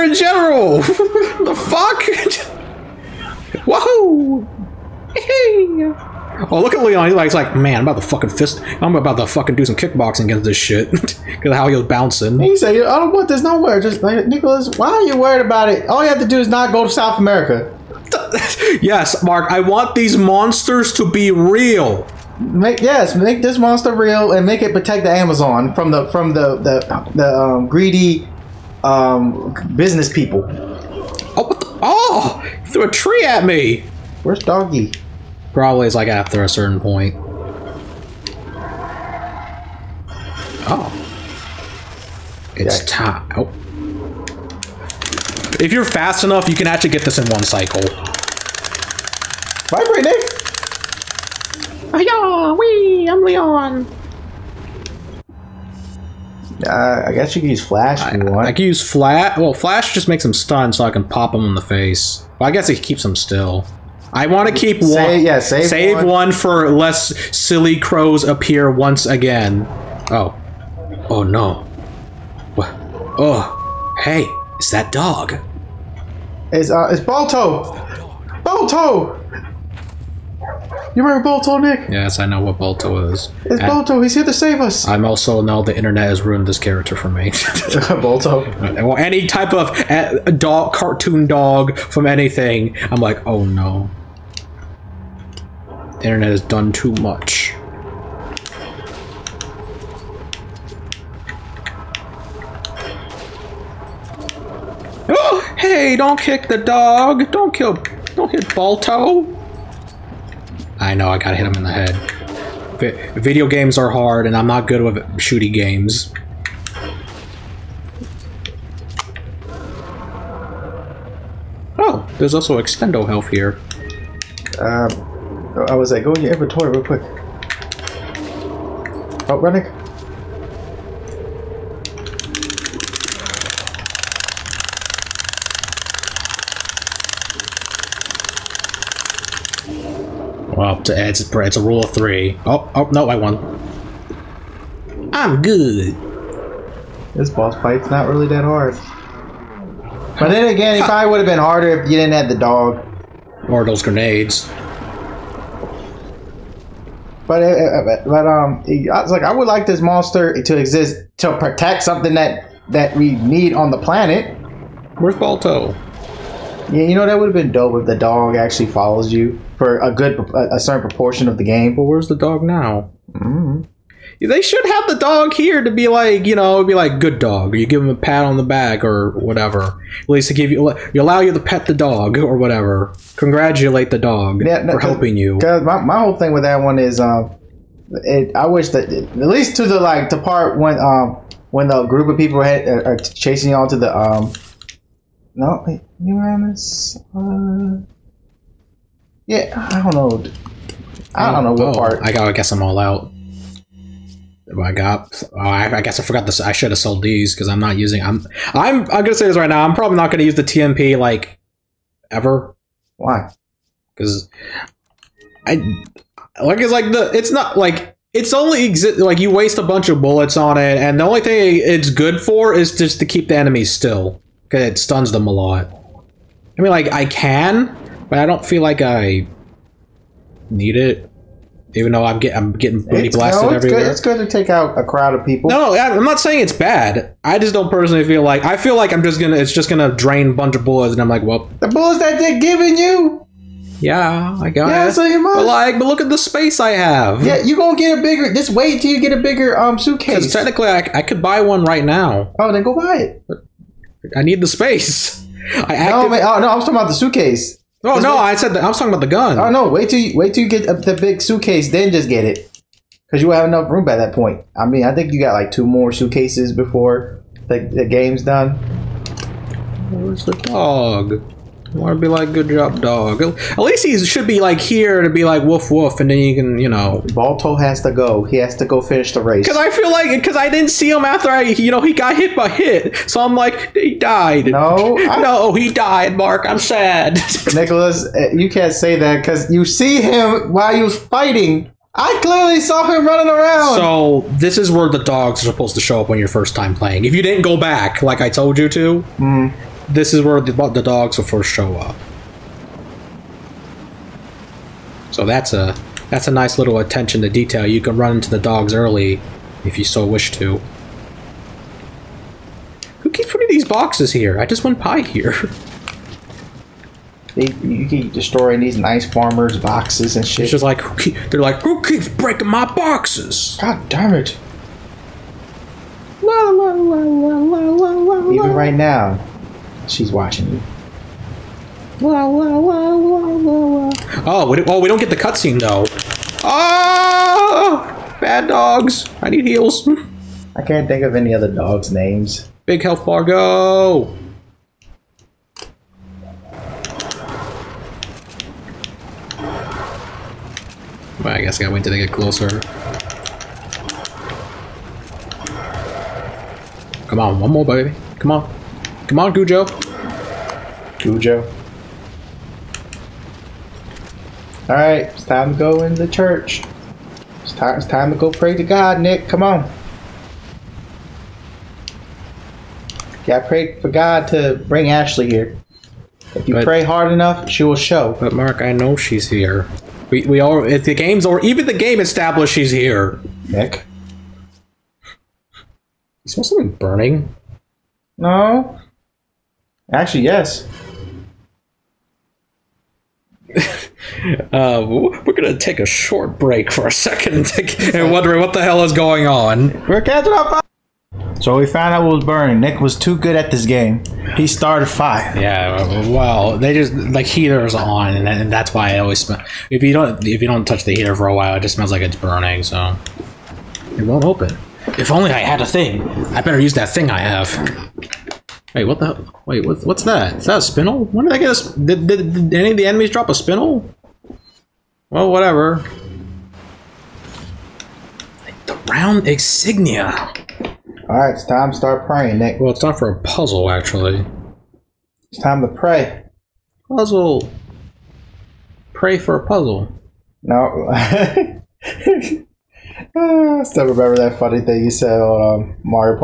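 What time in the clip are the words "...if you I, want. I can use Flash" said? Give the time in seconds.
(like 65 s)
58 s.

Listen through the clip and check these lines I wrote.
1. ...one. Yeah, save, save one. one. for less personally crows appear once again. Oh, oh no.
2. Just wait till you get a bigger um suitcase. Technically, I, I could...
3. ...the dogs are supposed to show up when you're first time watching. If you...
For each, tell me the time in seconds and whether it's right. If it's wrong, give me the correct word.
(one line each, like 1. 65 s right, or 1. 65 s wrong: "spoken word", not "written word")
1. 65 s wrong: "silly", not "personally"
2. 248 s right
3. 294 s wrong: "playing", not "watching".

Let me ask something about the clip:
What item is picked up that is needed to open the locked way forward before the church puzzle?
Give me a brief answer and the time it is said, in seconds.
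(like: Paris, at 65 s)
round insignia, at 428 s.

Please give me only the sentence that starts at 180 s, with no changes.
At least they give you, you allow you to pet the dog or whatever.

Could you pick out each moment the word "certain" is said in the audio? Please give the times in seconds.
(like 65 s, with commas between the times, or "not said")
36 s, 170 s.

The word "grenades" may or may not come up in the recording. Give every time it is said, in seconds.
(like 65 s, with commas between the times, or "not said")
153 s.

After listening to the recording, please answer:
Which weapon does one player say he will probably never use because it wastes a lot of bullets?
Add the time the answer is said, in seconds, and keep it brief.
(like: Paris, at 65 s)
TMP, at 210 s.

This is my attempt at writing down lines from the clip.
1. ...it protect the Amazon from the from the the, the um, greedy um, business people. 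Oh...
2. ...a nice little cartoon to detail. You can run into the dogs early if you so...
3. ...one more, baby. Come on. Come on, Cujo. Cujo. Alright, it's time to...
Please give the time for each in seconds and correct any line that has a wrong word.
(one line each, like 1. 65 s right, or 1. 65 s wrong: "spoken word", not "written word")
1. 24 s right
2. 306 s wrong: "attention", not "cartoon"
3. 357 s right.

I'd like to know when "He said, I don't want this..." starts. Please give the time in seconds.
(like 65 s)
12 s.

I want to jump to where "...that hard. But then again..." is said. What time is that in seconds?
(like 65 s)
148 s.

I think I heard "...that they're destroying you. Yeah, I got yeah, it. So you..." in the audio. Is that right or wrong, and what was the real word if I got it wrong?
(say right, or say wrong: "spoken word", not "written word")
wrong: "giving", not "destroying".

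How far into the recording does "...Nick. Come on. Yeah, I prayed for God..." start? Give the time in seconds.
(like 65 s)
369 s.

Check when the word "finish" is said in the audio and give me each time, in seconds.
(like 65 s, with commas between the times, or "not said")
278 s.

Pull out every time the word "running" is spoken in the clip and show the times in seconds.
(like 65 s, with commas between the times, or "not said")
129 s, 293 s.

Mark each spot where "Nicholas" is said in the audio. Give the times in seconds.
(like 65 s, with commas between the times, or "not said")
14 s, 287 s.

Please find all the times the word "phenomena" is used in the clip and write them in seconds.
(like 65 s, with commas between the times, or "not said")
not said.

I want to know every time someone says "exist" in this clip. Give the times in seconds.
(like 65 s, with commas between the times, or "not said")
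160 s, 218 s.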